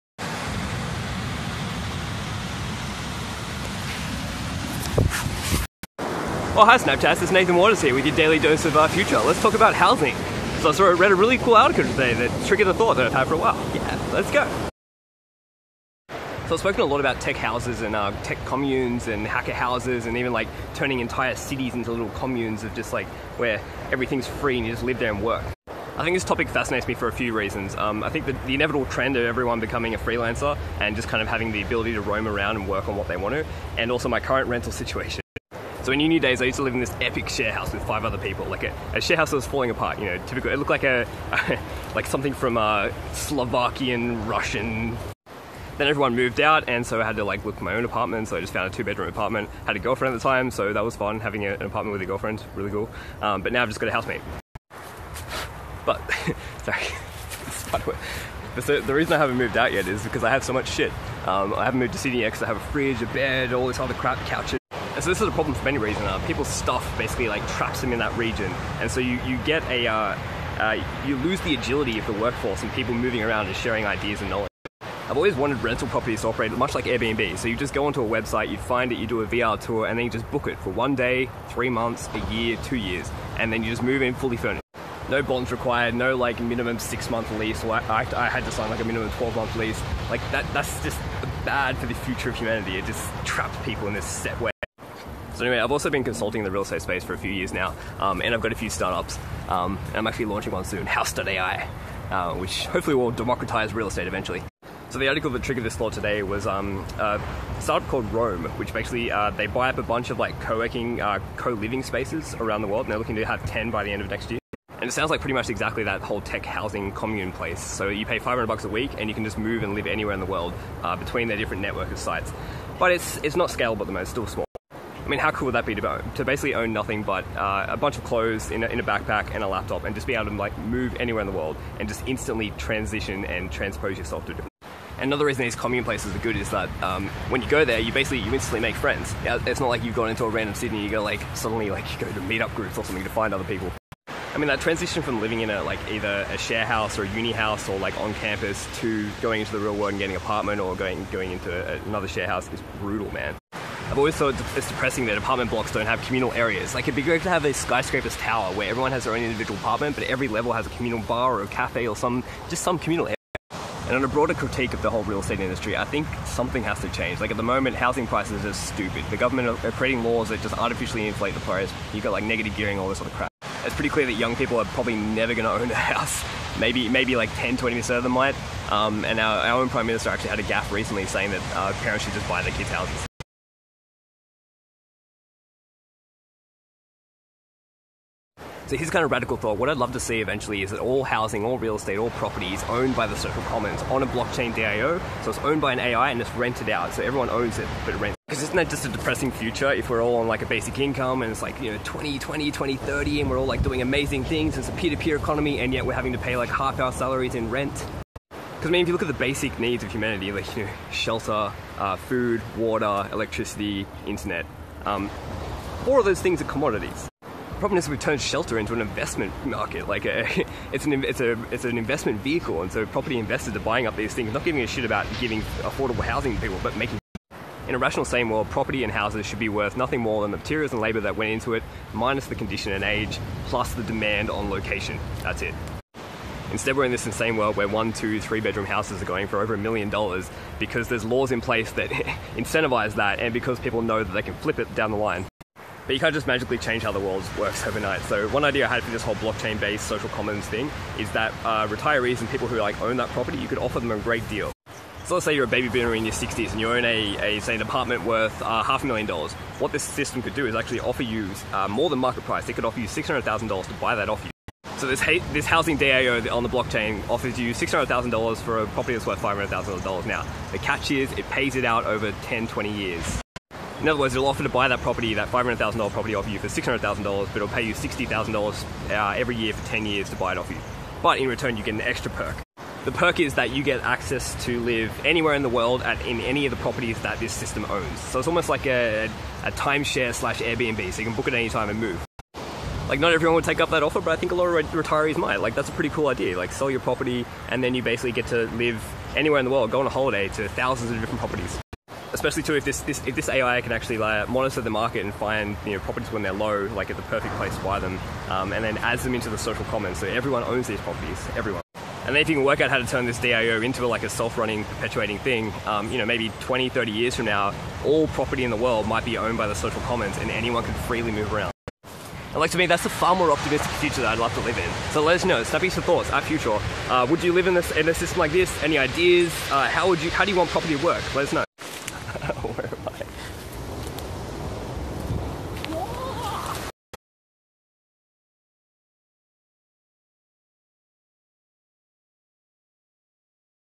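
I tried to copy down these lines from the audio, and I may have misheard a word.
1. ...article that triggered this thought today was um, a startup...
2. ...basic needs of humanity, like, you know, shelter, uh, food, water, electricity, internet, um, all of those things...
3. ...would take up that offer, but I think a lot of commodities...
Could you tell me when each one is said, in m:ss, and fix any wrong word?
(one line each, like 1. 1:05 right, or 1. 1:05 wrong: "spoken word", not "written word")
1. 1:45 right
2. 3:29 right
3. 4:53 wrong: "retirees", not "commodities".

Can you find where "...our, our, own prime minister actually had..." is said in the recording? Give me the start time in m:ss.
2:59.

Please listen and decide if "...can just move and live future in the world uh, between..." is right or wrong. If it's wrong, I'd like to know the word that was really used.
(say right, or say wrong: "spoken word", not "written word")
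wrong: "anywhere", not "future".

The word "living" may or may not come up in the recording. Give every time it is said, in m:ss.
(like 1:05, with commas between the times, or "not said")
1:51, 2:25.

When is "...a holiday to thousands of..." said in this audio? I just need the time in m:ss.
4:59.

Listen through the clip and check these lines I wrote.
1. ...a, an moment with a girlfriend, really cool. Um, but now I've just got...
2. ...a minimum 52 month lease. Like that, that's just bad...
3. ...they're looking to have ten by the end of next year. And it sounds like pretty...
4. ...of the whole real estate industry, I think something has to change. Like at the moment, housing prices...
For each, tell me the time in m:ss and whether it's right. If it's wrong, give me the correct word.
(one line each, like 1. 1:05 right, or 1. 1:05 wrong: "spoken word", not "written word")
1. 0:51 wrong: "apartment", not "moment"
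2. 1:28 wrong: "12", not "52"
3. 1:52 right
4. 2:44 right.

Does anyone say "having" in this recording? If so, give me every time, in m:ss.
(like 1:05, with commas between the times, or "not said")
0:31, 0:51, 3:25.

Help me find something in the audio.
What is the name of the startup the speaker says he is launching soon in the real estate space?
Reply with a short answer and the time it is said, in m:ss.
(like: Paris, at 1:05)
House.ai, at 1:40.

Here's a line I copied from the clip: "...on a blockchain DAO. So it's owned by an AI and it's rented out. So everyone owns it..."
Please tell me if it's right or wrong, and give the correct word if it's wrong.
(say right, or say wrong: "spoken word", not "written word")
right.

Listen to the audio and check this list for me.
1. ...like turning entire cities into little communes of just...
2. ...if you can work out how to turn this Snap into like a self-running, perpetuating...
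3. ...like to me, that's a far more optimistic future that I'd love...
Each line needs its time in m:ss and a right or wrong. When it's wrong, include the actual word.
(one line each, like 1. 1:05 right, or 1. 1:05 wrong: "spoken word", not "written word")
1. 0:20 right
2. 5:12 wrong: "DAO", not "Snap"
3. 5:22 right.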